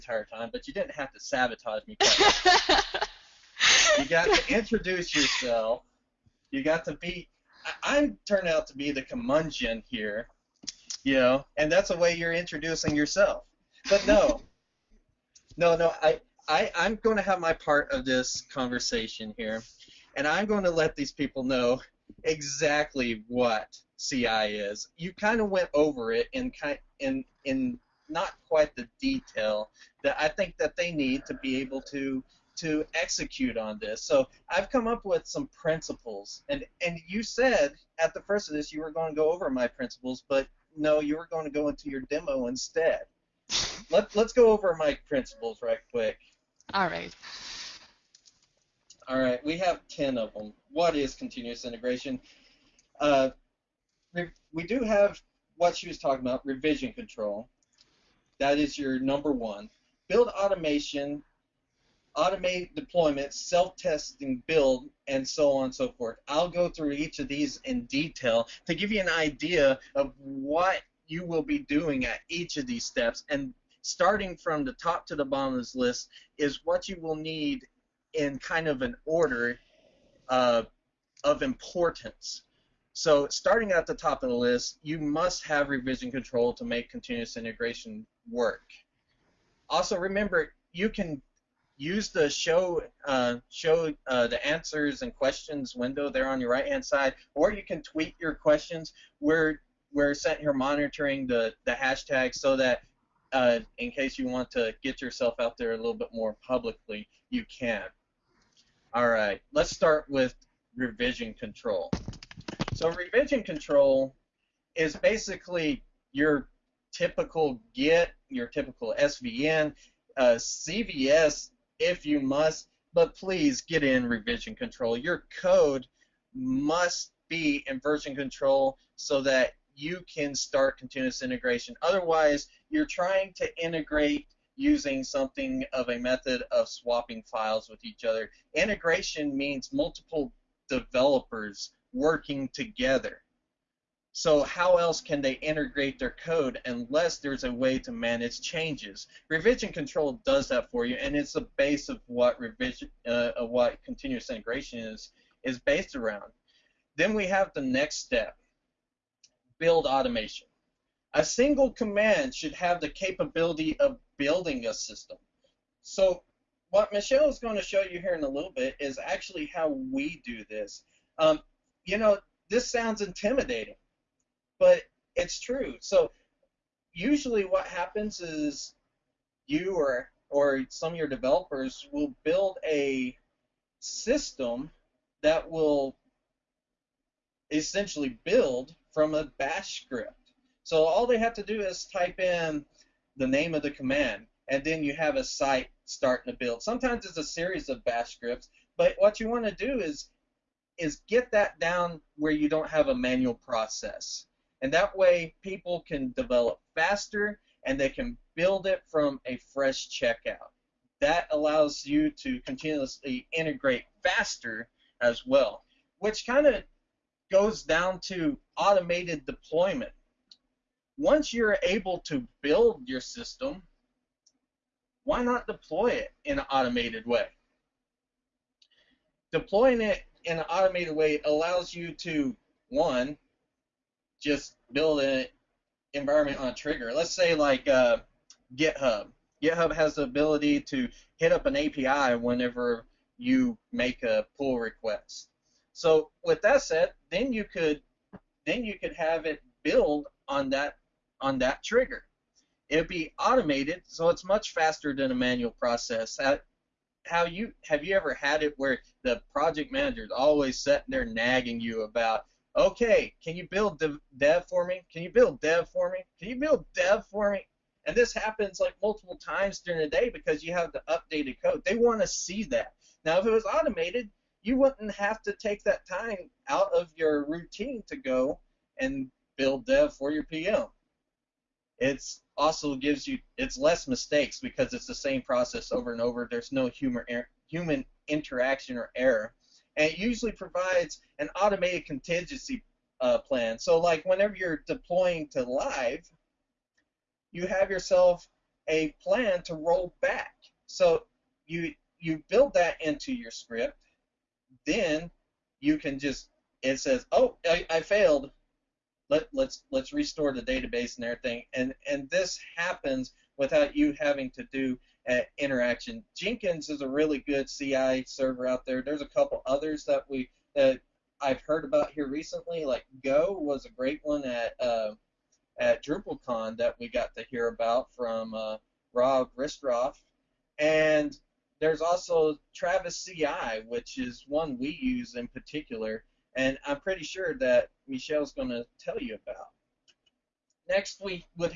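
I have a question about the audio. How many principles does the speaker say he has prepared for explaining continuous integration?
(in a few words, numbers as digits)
10.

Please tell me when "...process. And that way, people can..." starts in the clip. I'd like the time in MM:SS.
03:23.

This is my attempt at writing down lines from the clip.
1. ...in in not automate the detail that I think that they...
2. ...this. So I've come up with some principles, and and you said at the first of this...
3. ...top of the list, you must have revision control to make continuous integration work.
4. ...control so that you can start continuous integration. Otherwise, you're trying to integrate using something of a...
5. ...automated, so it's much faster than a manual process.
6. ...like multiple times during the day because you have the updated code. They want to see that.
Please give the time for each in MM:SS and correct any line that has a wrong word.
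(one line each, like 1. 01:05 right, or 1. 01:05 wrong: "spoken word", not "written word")
1. 00:27 wrong: "quite", not "automate"
2. 00:33 right
3. 01:23 right
4. 02:08 right
5. 04:13 right
6. 04:28 right.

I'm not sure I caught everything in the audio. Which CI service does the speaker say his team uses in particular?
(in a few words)
Travis CI.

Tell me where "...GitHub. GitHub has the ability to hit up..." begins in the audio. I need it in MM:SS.
03:58.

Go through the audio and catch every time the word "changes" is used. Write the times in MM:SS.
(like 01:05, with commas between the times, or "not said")
02:28.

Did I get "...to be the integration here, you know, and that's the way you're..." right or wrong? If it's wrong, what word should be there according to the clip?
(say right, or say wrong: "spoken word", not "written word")
wrong: "curmudgeon", not "integration".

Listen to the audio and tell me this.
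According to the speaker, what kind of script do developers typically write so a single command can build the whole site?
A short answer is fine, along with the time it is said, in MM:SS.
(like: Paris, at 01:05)
bash script, at 03:09.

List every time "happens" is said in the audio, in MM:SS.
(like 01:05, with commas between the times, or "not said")
02:57, 04:28, 05:12.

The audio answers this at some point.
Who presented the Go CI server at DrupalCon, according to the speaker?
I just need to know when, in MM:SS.
05:28.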